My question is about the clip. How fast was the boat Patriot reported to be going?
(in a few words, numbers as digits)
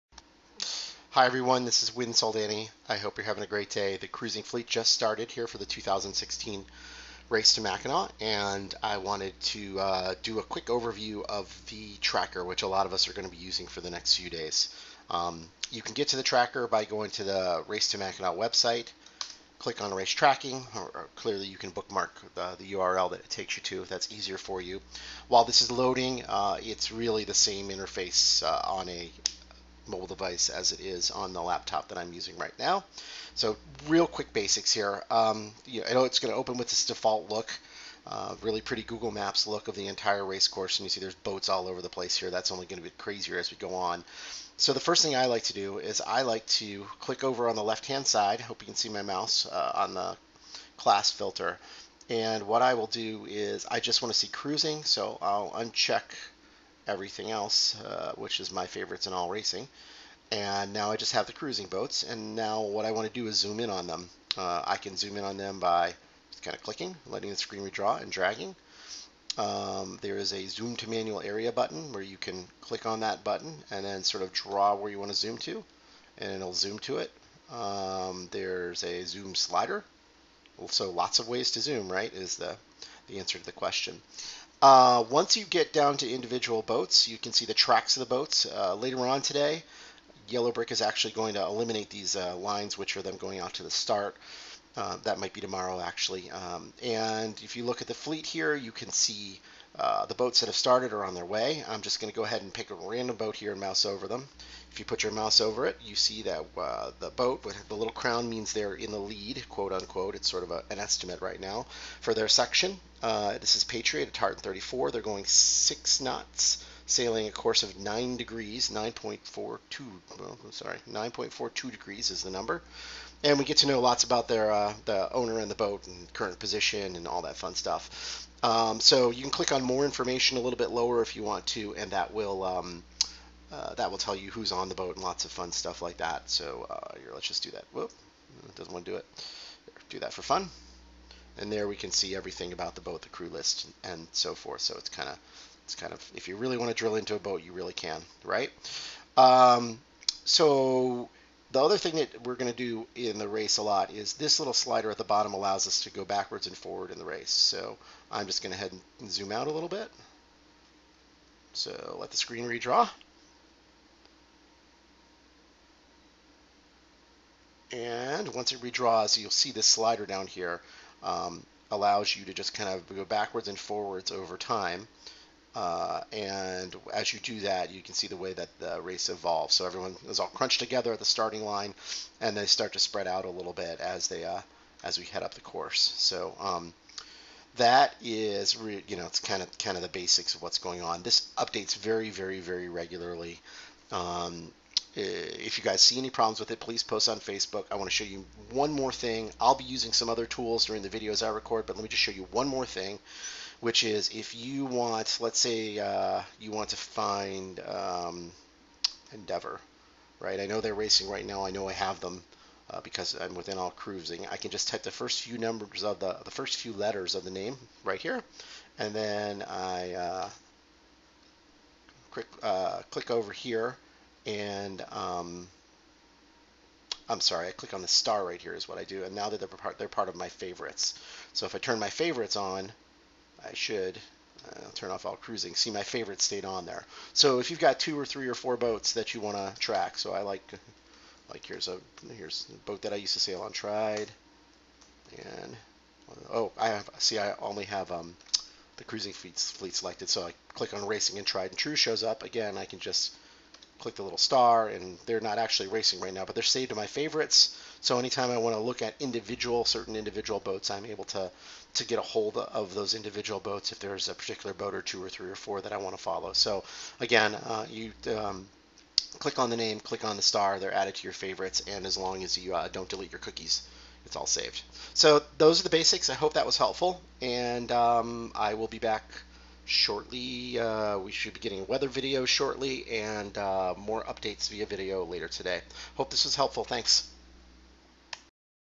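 6 knots.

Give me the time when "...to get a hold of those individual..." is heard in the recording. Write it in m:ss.
4:21.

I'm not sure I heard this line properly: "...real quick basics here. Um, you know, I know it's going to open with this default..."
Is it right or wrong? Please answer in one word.
right.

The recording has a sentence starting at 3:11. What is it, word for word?
This updates very very very regularly.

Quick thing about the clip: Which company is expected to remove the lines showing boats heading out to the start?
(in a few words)
Yellow Brick.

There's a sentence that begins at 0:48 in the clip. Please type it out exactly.
I Hope you can see my mouse uh, on the class filter.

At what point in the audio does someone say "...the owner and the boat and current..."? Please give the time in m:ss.
2:04.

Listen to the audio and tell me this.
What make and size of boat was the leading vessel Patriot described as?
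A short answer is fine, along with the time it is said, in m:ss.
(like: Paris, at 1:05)
Tartan 34, at 1:54.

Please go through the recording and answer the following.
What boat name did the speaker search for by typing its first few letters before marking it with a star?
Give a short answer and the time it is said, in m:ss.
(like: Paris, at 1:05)
Endeavor, at 3:29.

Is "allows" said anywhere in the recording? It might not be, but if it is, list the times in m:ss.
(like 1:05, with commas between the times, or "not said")
2:35, 2:51.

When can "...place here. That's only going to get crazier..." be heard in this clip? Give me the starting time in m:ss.
0:41.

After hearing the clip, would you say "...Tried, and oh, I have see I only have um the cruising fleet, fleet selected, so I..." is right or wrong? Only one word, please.
right.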